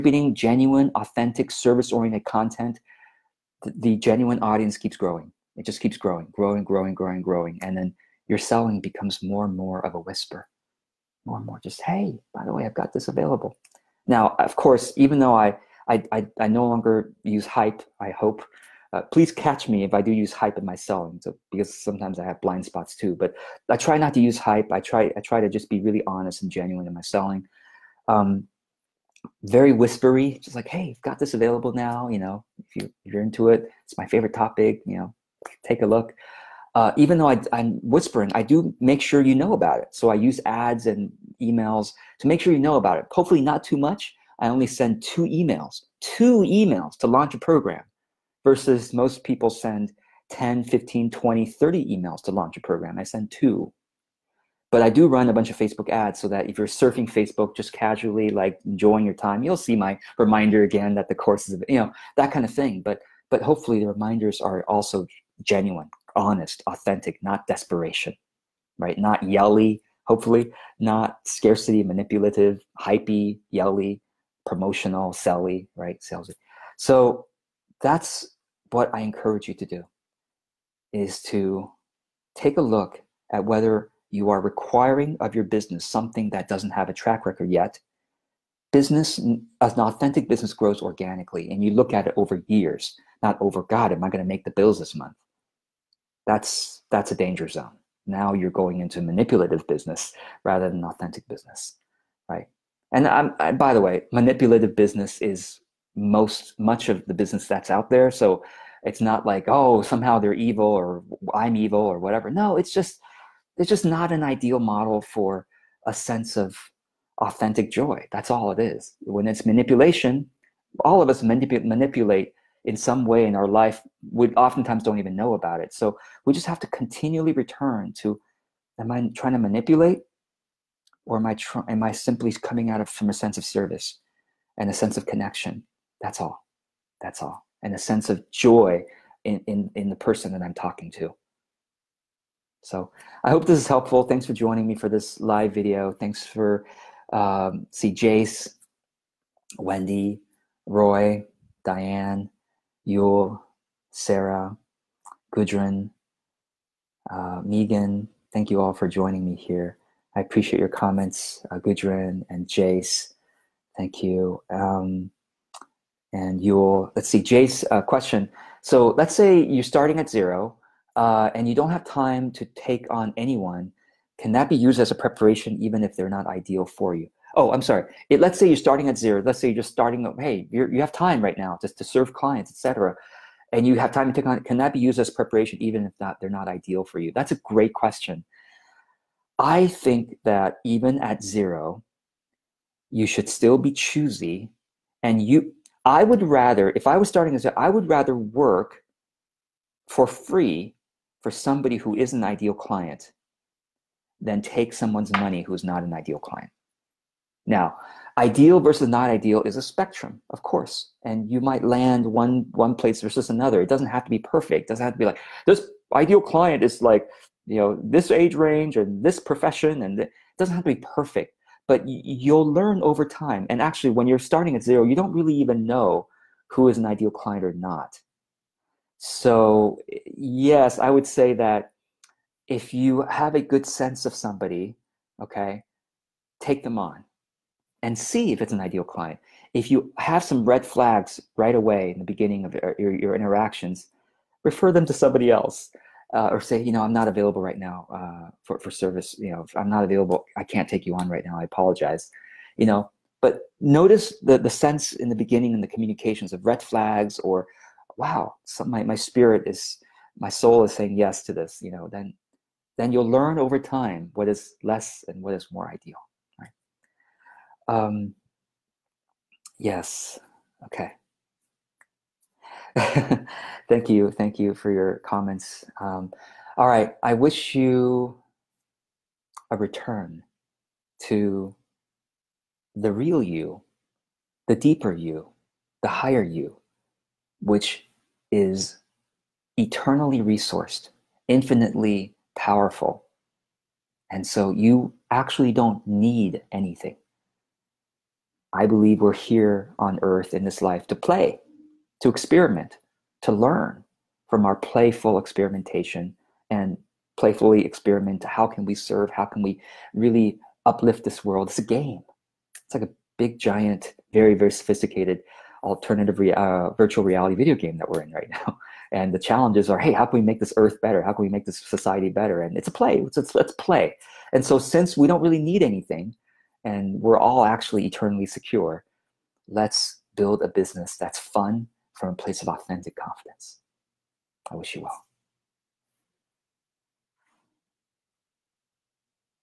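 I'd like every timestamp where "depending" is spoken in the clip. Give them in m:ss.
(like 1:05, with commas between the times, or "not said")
not said.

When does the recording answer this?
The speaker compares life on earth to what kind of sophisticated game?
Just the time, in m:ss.
5:16.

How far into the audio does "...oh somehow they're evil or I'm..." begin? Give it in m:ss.
1:49.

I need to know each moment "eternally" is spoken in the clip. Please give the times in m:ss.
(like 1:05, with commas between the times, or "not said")
4:49, 5:27.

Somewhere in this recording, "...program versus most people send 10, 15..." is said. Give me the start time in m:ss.
0:47.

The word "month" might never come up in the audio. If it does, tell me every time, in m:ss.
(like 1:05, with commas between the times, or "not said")
1:34.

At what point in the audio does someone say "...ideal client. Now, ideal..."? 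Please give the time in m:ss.
3:25.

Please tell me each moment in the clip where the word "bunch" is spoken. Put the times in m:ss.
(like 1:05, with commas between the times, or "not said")
0:55.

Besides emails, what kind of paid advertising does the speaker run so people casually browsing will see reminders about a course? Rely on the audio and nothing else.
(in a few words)
Facebook ads.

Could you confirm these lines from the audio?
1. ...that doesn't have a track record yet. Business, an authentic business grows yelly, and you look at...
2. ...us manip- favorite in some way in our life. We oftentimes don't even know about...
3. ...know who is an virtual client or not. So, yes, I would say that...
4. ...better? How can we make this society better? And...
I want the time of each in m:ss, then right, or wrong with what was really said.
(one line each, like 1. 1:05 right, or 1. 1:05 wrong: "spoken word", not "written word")
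1. 1:26 wrong: "organically", not "yelly"
2. 2:01 wrong: "manipulate", not "favorite"
3. 3:45 wrong: "ideal", not "virtual"
4. 5:20 right.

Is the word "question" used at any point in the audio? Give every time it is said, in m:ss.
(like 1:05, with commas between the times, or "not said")
2:47, 3:07.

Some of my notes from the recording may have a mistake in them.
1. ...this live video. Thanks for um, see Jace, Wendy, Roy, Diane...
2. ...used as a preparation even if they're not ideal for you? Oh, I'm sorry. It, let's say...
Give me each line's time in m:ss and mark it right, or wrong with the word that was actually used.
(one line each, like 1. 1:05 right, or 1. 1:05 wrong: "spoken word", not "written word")
1. 2:24 right
2. 2:54 right.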